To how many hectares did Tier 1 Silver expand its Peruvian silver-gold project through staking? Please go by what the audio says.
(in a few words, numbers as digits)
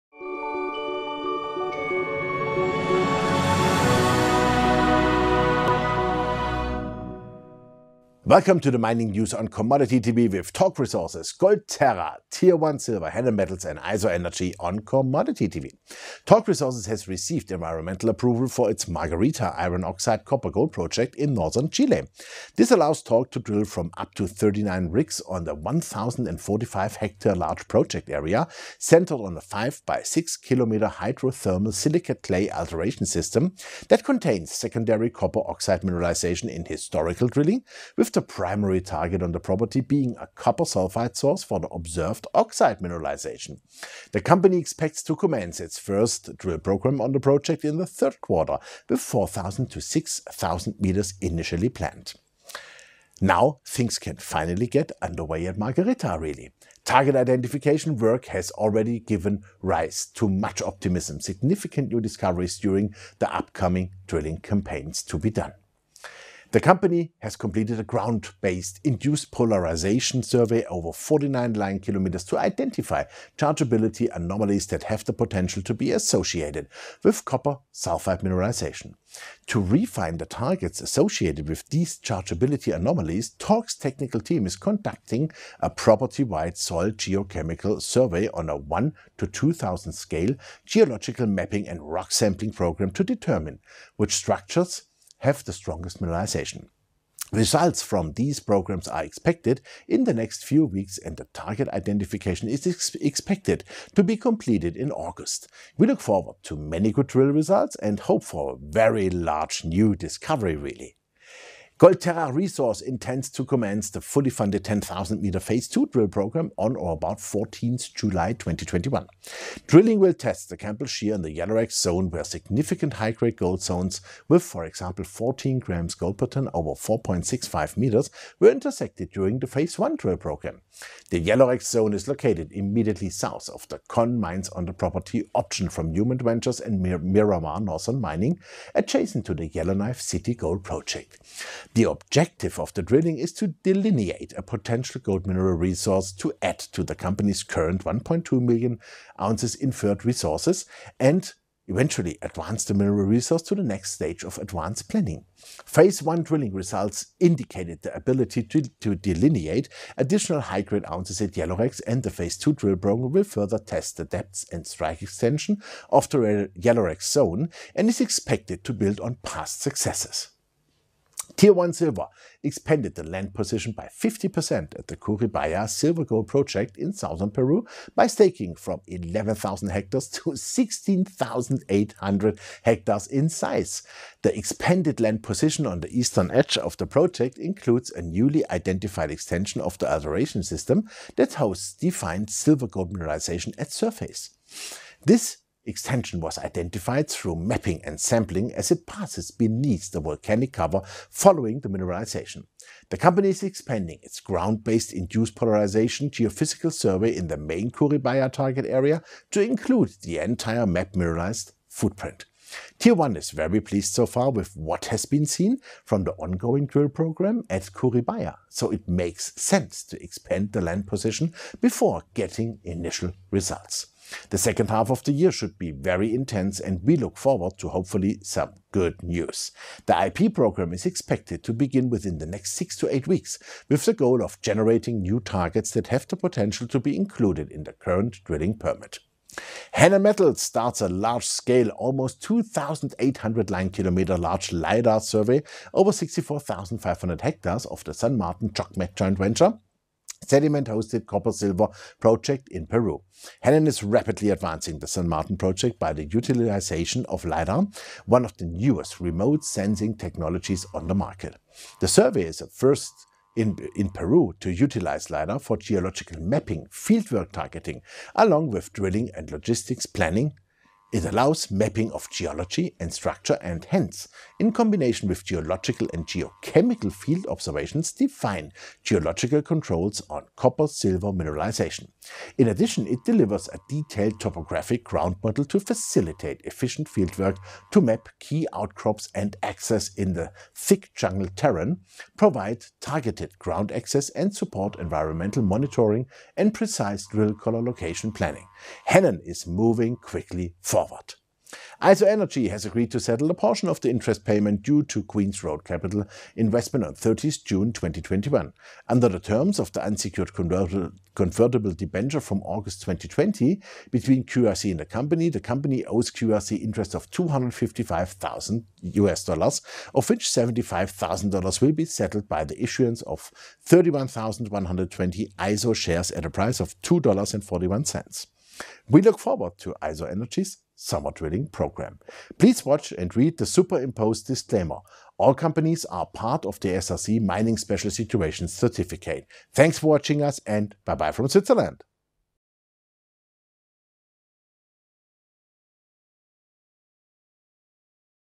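16,800 hectares.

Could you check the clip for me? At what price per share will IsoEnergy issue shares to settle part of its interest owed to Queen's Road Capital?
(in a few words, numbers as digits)
$2.41.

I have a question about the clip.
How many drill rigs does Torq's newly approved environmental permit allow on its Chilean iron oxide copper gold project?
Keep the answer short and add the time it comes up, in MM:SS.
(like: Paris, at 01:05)
39, at 00:24.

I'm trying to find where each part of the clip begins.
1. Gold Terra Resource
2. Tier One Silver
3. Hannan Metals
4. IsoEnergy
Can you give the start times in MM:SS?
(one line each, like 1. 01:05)
1. 01:51
2. 02:50
3. 04:00
4. 05:02.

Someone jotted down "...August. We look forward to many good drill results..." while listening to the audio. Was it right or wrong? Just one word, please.
right.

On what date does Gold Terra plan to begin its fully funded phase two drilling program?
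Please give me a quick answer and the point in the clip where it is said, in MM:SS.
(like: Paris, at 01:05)
14 July 2021, at 01:57.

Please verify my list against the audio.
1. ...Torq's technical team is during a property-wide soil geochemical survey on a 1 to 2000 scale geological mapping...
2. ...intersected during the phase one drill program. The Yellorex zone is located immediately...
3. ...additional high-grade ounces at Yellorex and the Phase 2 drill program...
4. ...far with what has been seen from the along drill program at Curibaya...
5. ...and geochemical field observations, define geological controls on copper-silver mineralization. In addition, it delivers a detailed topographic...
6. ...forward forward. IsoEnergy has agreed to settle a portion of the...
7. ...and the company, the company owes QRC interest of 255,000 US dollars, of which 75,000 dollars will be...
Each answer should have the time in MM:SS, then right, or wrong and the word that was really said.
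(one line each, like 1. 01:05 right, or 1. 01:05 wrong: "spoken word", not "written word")
1. 01:23 wrong: "conducting", not "during"
2. 02:08 right
3. 02:39 right
4. 03:34 wrong: "ongoing", not "along"
5. 04:35 right
6. 05:00 right
7. 05:14 right.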